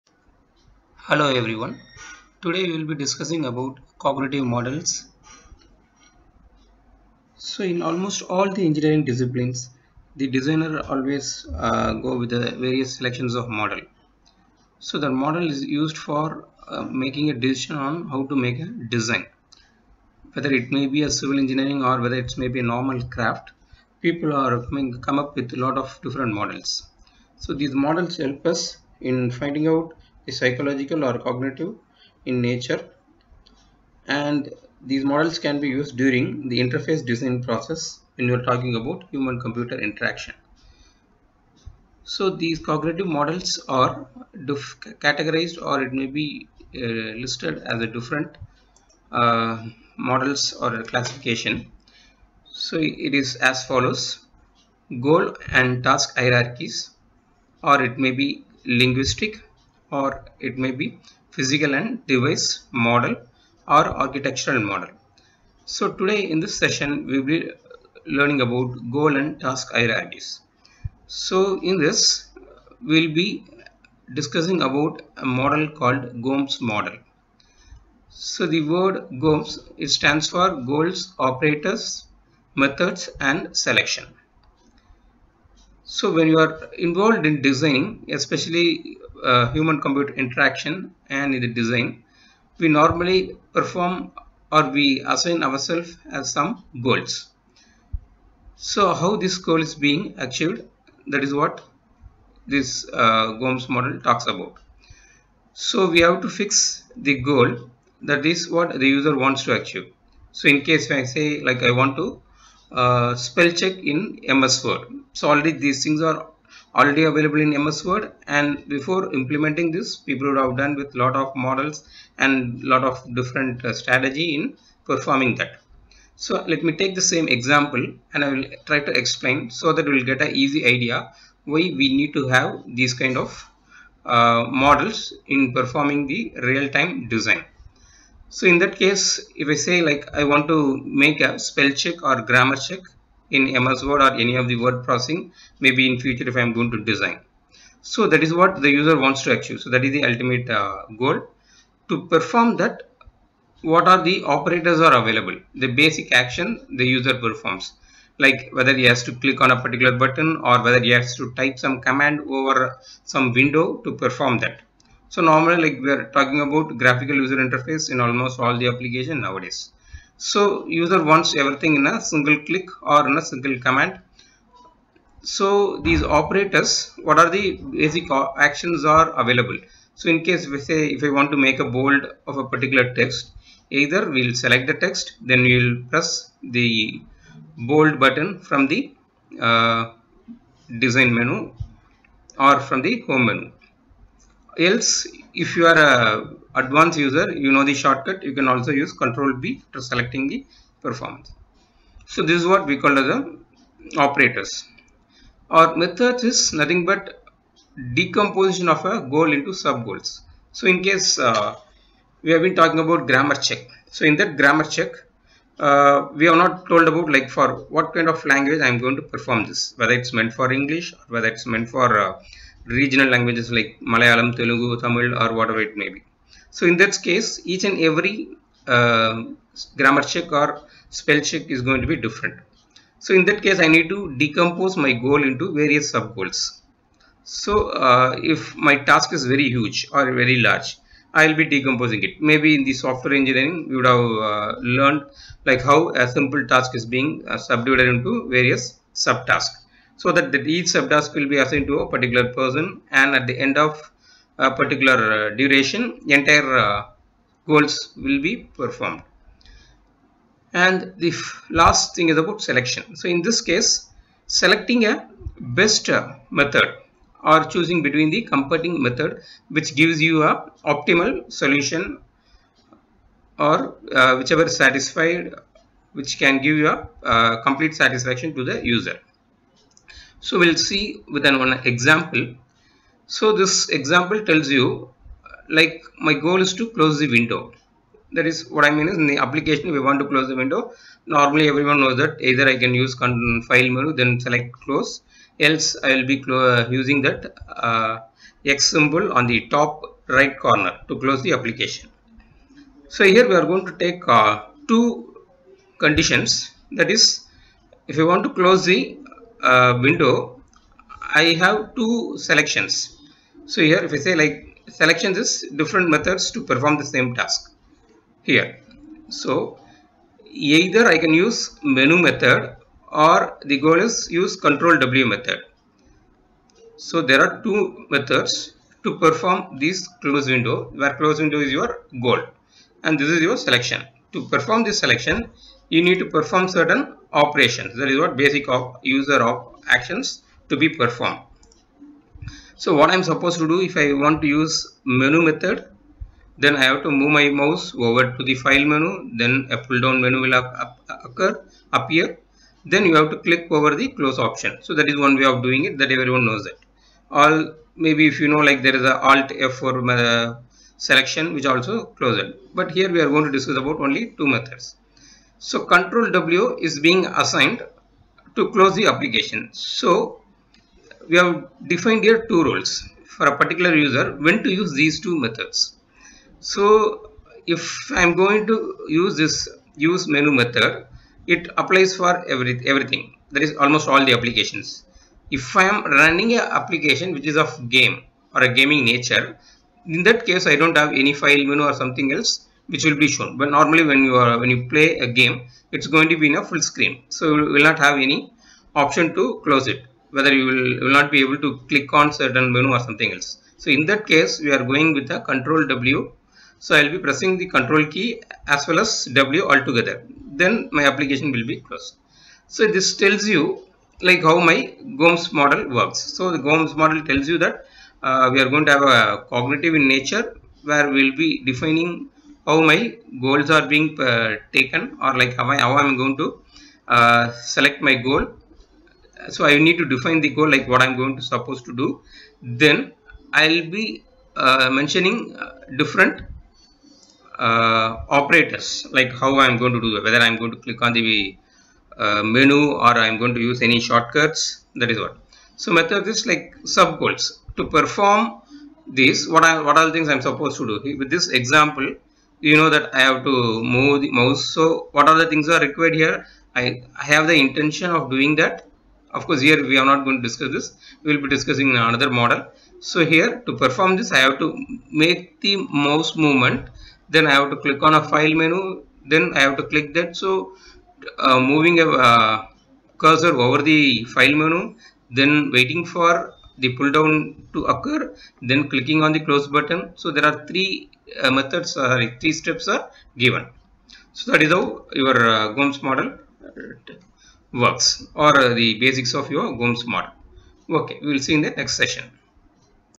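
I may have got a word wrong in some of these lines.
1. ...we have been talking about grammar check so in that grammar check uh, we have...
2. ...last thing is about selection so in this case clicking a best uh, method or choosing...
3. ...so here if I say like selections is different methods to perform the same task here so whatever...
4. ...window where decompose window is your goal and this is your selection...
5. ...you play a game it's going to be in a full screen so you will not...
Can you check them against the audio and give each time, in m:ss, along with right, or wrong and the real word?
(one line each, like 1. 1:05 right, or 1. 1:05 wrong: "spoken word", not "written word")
1. 3:32 right
2. 4:21 wrong: "selecting", not "clicking"
3. 5:13 wrong: "either", not "whatever"
4. 5:30 wrong: "close", not "decompose"
5. 6:34 right.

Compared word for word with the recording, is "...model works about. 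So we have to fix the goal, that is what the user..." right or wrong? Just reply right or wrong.
wrong.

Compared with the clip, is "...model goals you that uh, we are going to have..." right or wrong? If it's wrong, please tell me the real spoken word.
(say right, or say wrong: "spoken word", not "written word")
wrong: "tells", not "goals".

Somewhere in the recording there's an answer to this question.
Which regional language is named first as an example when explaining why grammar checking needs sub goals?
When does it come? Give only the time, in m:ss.
3:43.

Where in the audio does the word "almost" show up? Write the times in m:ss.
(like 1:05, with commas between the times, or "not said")
0:07, 2:47, 6:23.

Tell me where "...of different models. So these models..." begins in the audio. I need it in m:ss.
0:25.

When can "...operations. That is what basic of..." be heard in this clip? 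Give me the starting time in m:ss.
5:37.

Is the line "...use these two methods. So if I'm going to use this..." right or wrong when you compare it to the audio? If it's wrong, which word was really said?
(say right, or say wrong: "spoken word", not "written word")
right.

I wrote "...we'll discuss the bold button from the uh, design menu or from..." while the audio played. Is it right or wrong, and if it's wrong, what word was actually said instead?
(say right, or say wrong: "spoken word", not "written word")
wrong: "press", not "discuss".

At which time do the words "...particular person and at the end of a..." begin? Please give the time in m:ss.
4:11.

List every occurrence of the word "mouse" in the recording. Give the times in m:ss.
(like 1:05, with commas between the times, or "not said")
5:47, 7:34, 7:45.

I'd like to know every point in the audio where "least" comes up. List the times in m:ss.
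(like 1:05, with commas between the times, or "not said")
not said.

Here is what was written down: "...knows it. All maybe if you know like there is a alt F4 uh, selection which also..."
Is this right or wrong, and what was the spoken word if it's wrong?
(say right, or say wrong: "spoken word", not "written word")
right.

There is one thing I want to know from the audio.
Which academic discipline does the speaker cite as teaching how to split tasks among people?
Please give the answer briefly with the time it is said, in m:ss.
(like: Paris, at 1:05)
software engineering, at 4:02.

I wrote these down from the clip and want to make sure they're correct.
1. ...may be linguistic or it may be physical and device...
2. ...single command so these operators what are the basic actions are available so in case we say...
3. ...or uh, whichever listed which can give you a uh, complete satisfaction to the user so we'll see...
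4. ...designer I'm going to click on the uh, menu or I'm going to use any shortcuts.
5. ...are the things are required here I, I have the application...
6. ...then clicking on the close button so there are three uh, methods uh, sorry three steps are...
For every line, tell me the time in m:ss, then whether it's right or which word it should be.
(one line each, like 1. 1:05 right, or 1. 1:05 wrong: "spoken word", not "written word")
1. 0:57 right
2. 2:53 right
3. 4:33 wrong: "satisfied", not "listed"
4. 7:20 wrong: "whether", not "designer"
5. 7:35 wrong: "intention", not "application"
6. 7:58 right.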